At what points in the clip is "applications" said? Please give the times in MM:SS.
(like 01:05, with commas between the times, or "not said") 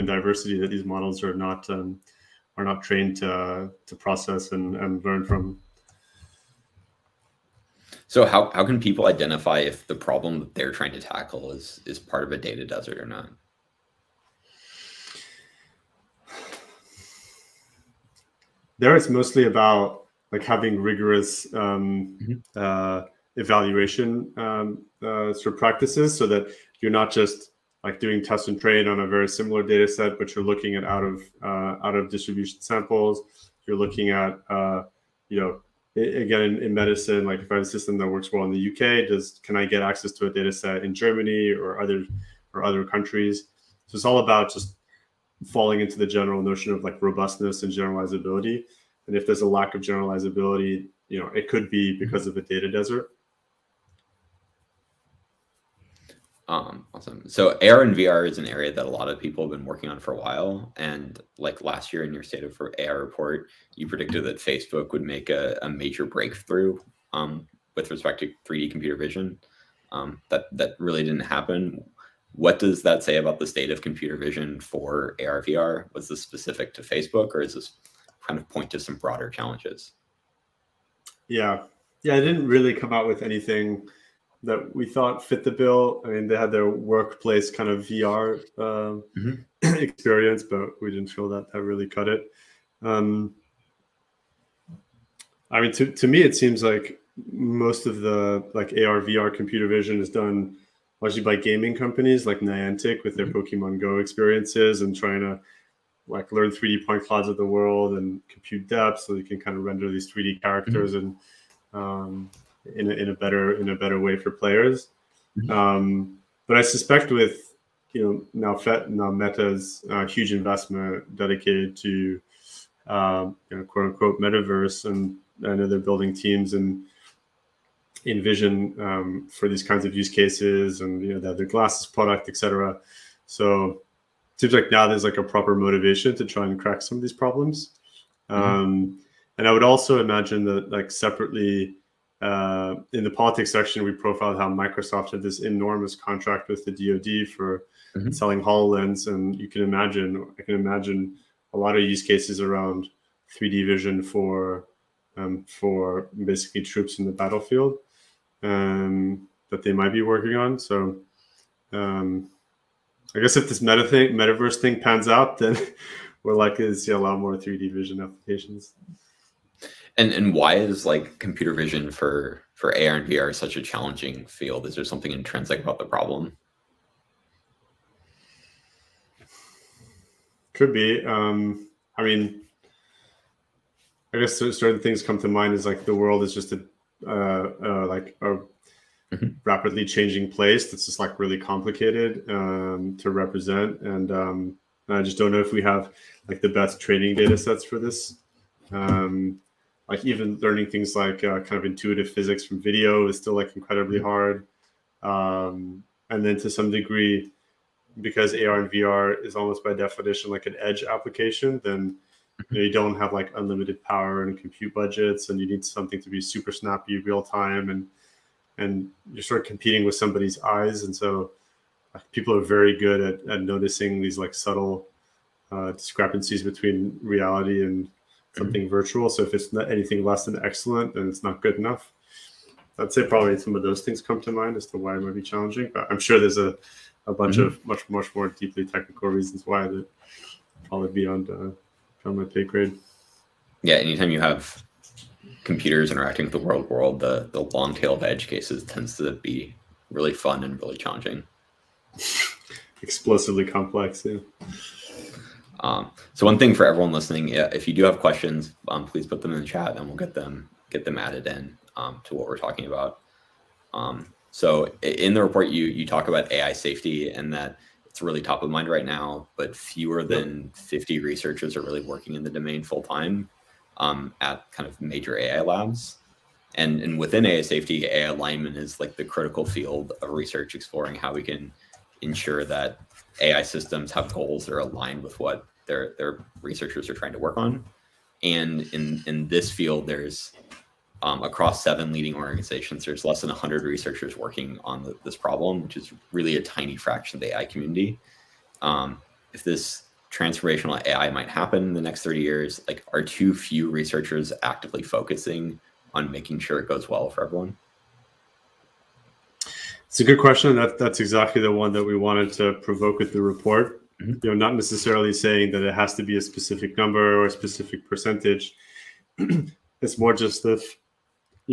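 02:48, 03:30.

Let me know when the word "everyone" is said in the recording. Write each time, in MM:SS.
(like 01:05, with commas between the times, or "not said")
04:16, 05:07.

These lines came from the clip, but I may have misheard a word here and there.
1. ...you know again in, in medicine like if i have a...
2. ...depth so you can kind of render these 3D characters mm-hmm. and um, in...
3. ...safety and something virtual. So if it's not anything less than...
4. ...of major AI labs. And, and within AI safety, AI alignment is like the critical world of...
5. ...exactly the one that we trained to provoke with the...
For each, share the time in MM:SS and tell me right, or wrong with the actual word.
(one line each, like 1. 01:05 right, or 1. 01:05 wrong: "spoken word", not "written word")
1. 00:35 right
2. 01:48 right
3. 03:47 wrong: "reality", not "safety"
4. 04:34 wrong: "field", not "world"
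5. 05:10 wrong: "wanted", not "trained".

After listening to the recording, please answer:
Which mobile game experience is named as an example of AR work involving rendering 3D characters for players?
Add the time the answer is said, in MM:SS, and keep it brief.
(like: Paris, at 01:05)
Pokemon Go, at 01:43.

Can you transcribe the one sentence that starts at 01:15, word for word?
Was this specific to Facebook, or is this kind of point to some broader challenges?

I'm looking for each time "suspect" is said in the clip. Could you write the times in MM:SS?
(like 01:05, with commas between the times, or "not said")
01:56.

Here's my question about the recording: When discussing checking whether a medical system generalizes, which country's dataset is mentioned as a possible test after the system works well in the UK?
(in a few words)
Germany.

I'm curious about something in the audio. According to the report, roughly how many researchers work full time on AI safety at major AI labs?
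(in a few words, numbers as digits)
fewer than 50.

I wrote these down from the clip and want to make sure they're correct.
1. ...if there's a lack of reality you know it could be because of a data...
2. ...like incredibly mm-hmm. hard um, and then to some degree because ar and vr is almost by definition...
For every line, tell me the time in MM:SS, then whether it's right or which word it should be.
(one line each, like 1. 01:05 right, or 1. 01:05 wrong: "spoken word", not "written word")
1. 00:49 wrong: "generalizability", not "reality"
2. 03:23 right.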